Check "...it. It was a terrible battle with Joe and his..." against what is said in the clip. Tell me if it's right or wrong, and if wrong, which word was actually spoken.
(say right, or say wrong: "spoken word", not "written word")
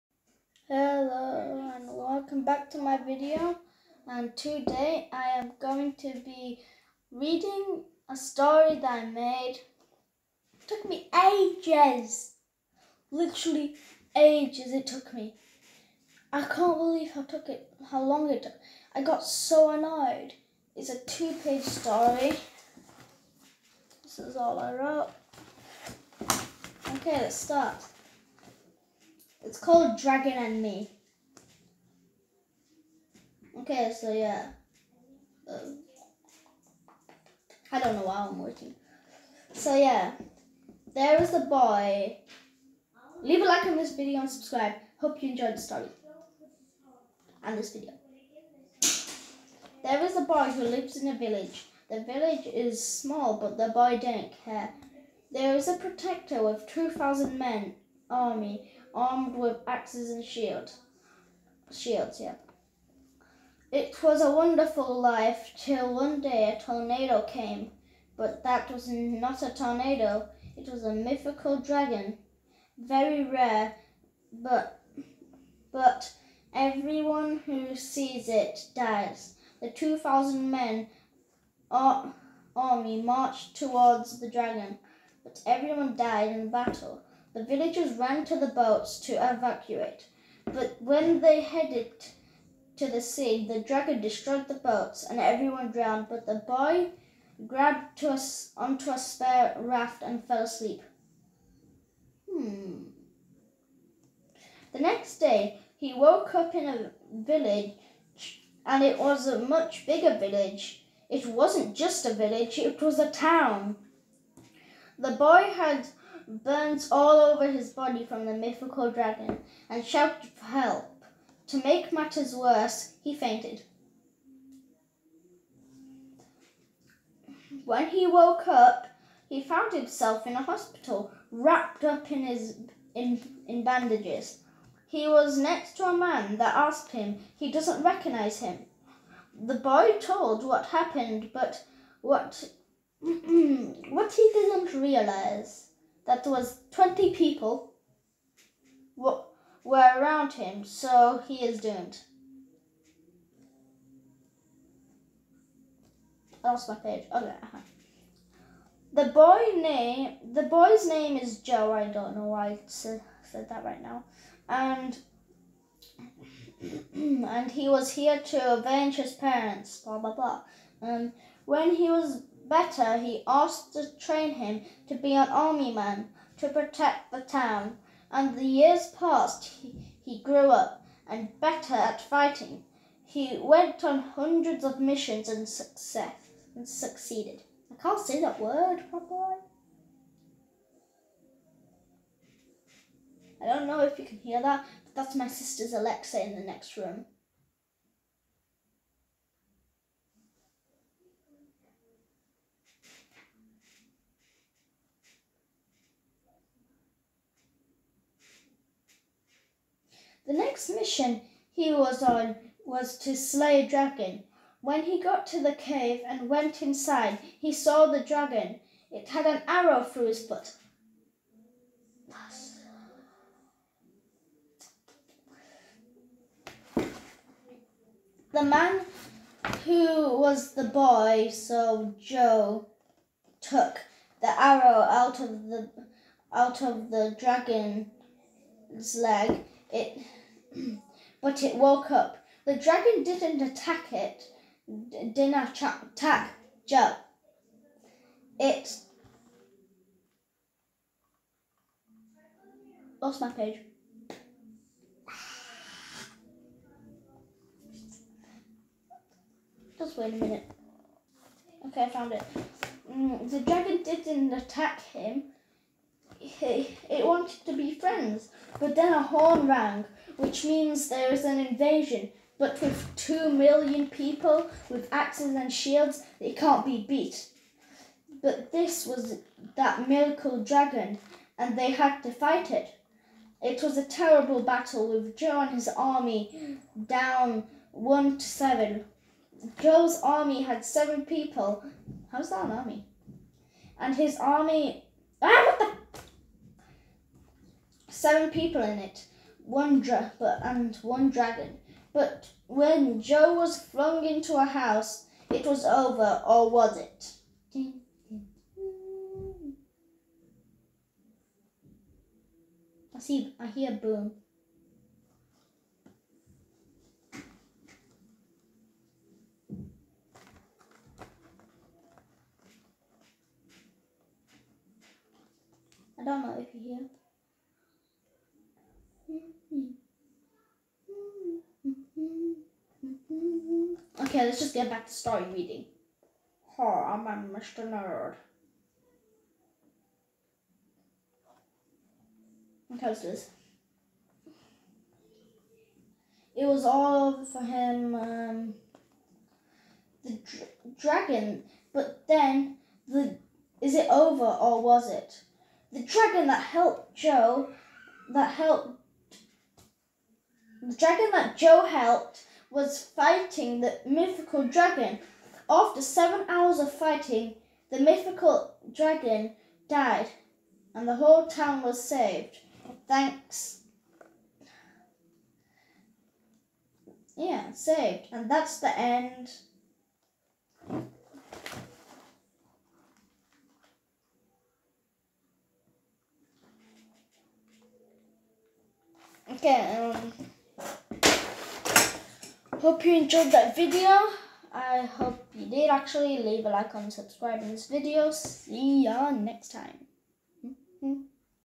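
right.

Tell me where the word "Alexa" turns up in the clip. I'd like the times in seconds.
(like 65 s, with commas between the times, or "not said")
195 s.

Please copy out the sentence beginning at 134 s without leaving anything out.
He was next to a man that asked him he doesn't recognize him.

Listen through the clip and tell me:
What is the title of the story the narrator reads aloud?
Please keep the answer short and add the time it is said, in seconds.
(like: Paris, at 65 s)
Dragon and Me, at 29 s.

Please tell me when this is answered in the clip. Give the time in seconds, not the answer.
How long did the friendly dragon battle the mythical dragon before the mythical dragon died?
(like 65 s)
365 s.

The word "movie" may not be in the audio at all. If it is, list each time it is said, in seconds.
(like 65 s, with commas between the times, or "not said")
not said.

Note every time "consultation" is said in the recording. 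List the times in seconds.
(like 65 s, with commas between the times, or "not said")
not said.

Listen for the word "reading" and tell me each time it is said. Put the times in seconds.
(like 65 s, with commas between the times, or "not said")
7 s, 335 s.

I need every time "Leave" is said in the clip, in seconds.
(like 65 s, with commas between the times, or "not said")
43 s, 396 s.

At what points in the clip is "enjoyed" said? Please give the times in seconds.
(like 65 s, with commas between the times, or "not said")
45 s, 392 s.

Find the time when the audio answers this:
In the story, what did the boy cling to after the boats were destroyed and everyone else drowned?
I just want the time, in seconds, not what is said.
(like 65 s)
98 s.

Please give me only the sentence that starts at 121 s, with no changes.
To make matters worse, he fainted.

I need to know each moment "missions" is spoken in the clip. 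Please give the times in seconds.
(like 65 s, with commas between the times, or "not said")
184 s, 210 s.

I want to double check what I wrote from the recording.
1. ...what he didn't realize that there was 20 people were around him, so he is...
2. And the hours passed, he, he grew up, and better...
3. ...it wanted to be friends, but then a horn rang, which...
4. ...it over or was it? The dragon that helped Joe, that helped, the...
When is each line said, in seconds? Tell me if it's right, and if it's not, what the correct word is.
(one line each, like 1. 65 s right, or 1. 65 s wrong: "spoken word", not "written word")
1. 143 s right
2. 178 s wrong: "years", not "hours"
3. 266 s right
4. 353 s right.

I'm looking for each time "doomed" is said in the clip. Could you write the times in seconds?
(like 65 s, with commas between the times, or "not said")
151 s.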